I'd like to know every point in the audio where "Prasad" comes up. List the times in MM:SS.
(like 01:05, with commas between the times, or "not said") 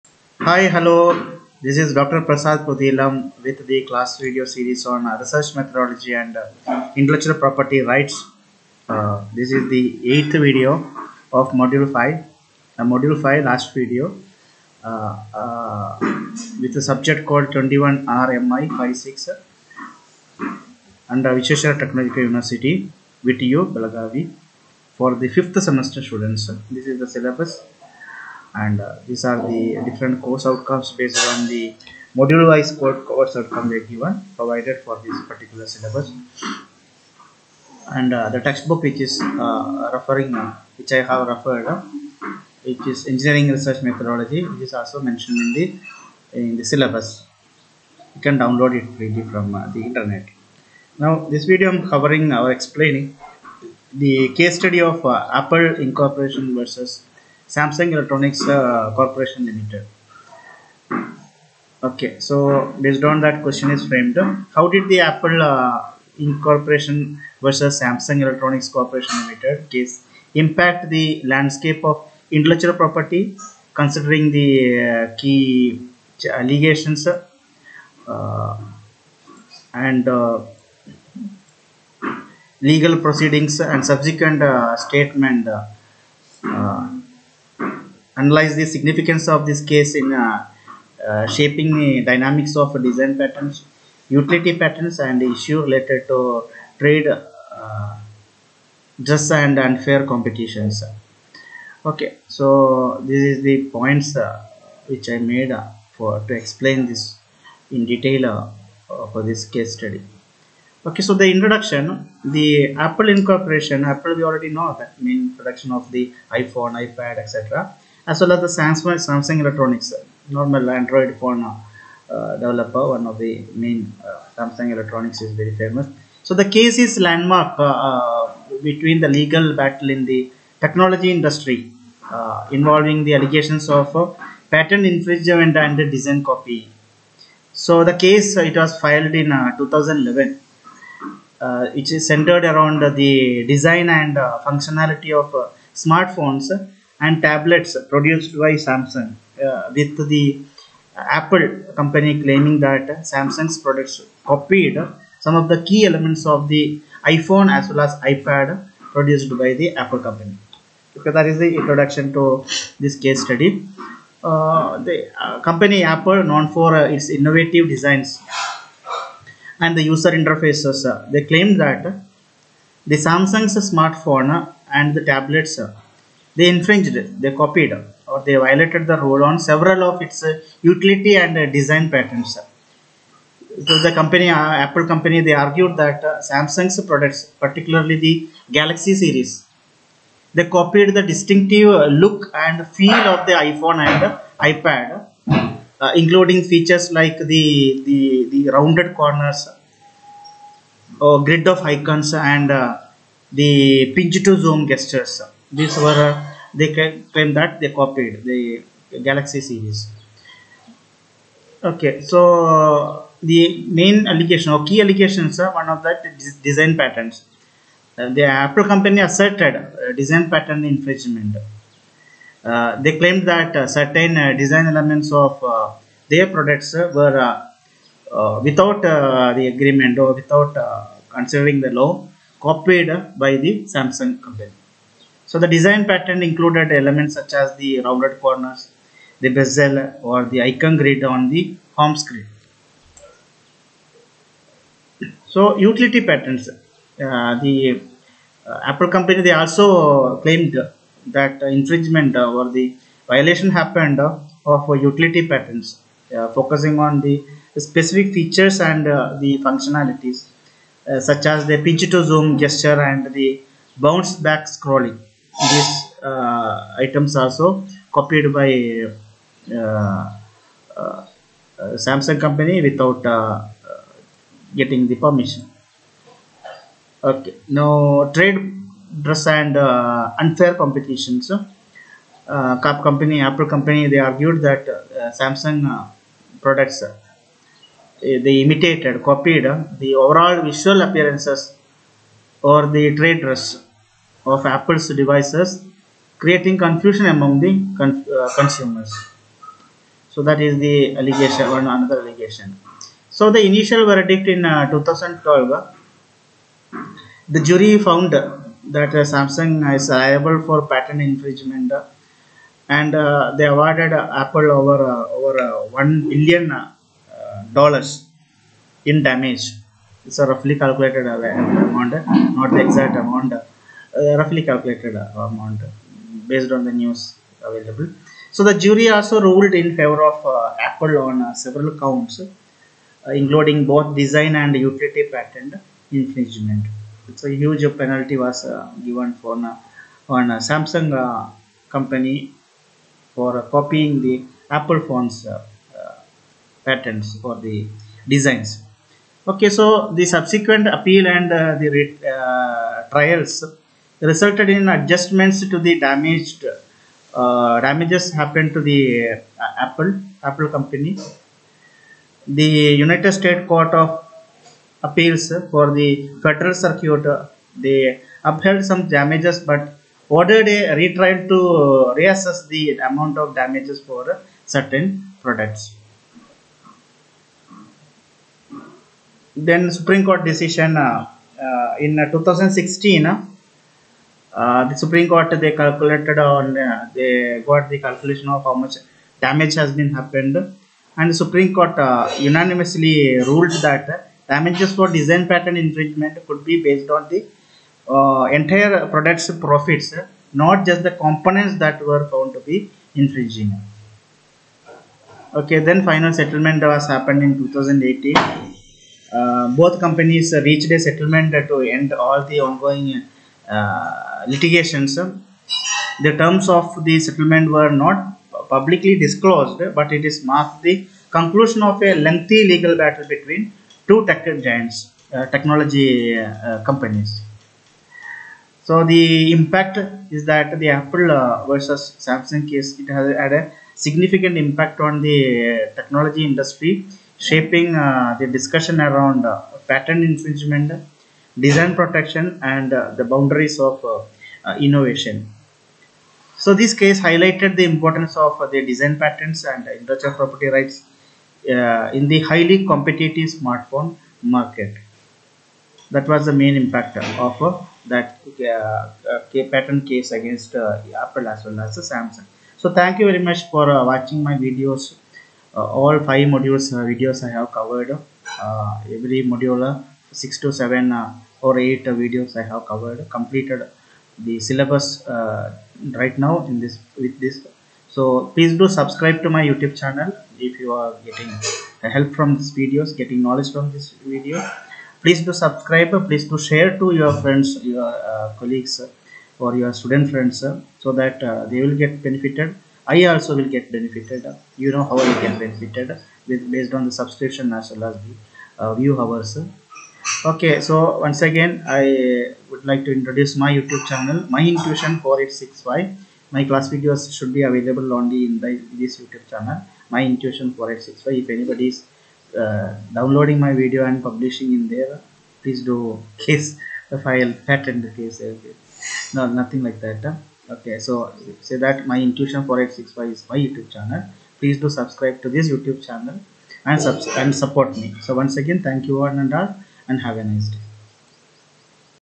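00:02.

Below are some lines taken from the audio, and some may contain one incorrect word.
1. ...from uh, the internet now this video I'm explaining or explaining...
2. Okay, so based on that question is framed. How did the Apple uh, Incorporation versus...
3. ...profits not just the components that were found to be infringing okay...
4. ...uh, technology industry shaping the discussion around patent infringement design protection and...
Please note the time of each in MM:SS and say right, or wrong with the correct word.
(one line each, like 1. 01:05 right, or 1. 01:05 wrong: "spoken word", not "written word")
1. 00:49 wrong: "covering", not "explaining"
2. 01:01 right
3. 06:39 right
4. 07:15 right.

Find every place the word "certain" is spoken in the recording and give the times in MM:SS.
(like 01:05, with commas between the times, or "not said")
03:43, 06:14.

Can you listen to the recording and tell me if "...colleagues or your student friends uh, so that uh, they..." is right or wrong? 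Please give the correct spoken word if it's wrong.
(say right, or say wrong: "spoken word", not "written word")
right.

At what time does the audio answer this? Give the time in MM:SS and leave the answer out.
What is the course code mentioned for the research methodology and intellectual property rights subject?
00:17.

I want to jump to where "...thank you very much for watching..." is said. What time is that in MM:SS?
07:42.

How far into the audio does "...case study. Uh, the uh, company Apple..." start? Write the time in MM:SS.
02:42.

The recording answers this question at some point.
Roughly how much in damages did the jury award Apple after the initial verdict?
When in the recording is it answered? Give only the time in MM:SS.
05:15.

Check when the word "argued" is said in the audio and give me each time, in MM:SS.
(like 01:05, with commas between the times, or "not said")
03:05, 04:44.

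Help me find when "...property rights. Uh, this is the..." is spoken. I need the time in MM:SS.
00:07.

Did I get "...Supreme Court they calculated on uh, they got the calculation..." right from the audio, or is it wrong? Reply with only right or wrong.
right.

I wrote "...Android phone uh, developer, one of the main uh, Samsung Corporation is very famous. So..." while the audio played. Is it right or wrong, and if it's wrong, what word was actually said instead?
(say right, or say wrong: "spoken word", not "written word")
wrong: "Electronics", not "Corporation".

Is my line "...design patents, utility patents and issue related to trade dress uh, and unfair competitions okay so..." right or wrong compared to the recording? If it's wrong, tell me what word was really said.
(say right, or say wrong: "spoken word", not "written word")
right.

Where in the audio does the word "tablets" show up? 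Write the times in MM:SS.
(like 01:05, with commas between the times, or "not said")
02:27, 02:55.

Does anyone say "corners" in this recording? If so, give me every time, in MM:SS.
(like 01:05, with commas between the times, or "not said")
03:18, 03:58.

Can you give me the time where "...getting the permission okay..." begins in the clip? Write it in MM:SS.
04:34.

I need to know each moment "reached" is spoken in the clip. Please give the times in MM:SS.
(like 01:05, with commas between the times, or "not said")
06:50.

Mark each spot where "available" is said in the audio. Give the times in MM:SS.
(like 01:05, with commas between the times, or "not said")
05:27, 08:27.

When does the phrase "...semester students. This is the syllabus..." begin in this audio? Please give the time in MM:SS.
00:25.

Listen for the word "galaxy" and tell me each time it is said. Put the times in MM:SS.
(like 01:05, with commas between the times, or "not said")
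03:08, 03:29.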